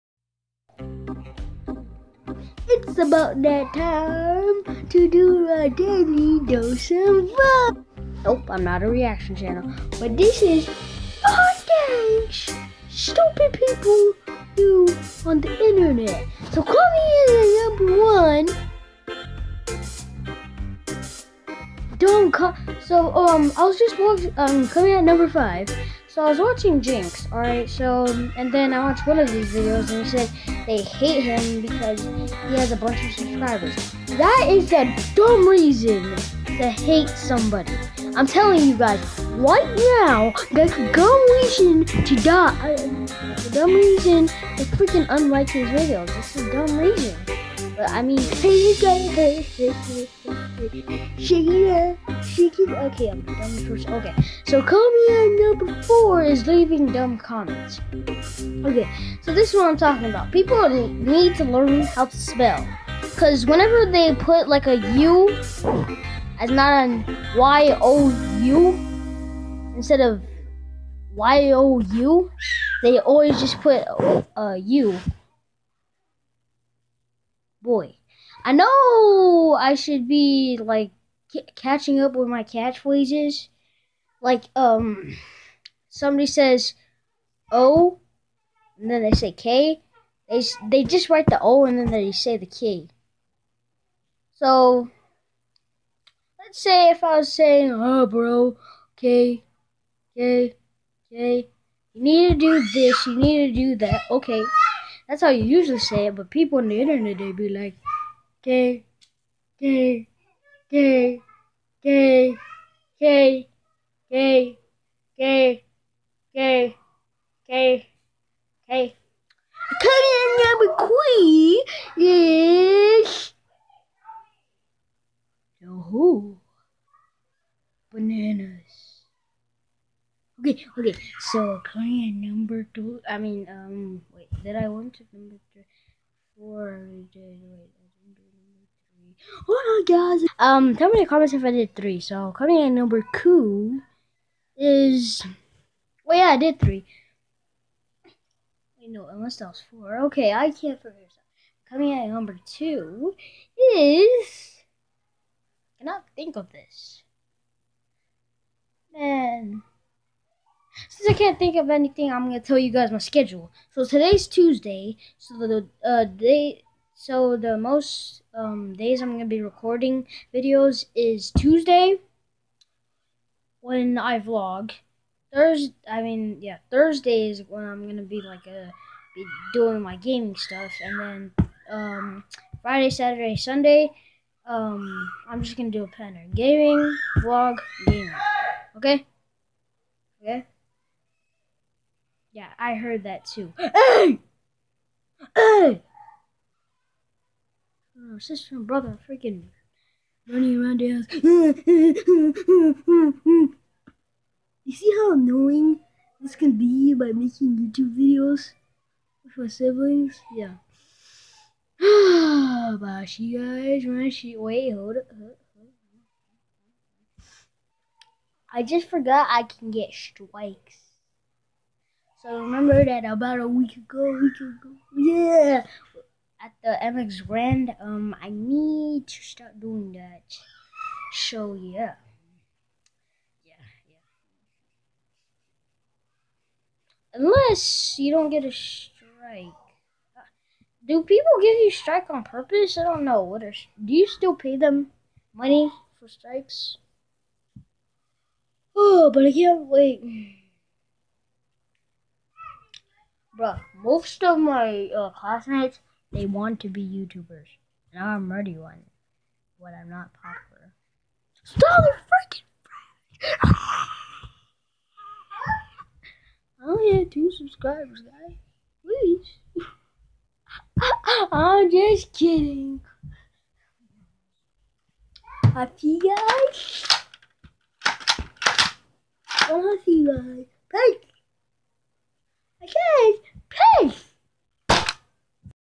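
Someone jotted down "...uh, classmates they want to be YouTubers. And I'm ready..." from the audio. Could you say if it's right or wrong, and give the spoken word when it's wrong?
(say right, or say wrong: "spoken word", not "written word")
right.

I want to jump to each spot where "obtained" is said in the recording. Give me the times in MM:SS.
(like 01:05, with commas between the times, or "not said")
not said.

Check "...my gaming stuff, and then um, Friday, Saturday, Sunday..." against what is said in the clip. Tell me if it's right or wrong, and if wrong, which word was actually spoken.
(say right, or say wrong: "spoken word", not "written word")
right.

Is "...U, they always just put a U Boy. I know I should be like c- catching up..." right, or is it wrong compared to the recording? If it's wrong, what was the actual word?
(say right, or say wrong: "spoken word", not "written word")
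right.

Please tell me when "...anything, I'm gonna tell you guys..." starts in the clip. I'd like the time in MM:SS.
02:41.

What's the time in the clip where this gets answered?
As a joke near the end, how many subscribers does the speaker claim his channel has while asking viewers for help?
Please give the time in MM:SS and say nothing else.
04:27.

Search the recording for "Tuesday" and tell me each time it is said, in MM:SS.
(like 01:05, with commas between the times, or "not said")
02:44, 02:51.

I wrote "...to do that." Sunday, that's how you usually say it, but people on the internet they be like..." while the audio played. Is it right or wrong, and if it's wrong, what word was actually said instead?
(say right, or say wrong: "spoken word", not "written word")
wrong: "Okay", not "Sunday".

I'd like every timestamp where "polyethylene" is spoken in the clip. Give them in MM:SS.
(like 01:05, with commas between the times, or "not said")
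not said.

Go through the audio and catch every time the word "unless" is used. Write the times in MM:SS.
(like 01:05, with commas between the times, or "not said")
02:29, 03:57.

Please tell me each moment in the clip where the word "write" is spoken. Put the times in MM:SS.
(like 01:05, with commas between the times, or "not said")
01:31.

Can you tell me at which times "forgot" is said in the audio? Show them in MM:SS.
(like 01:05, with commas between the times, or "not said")
03:38.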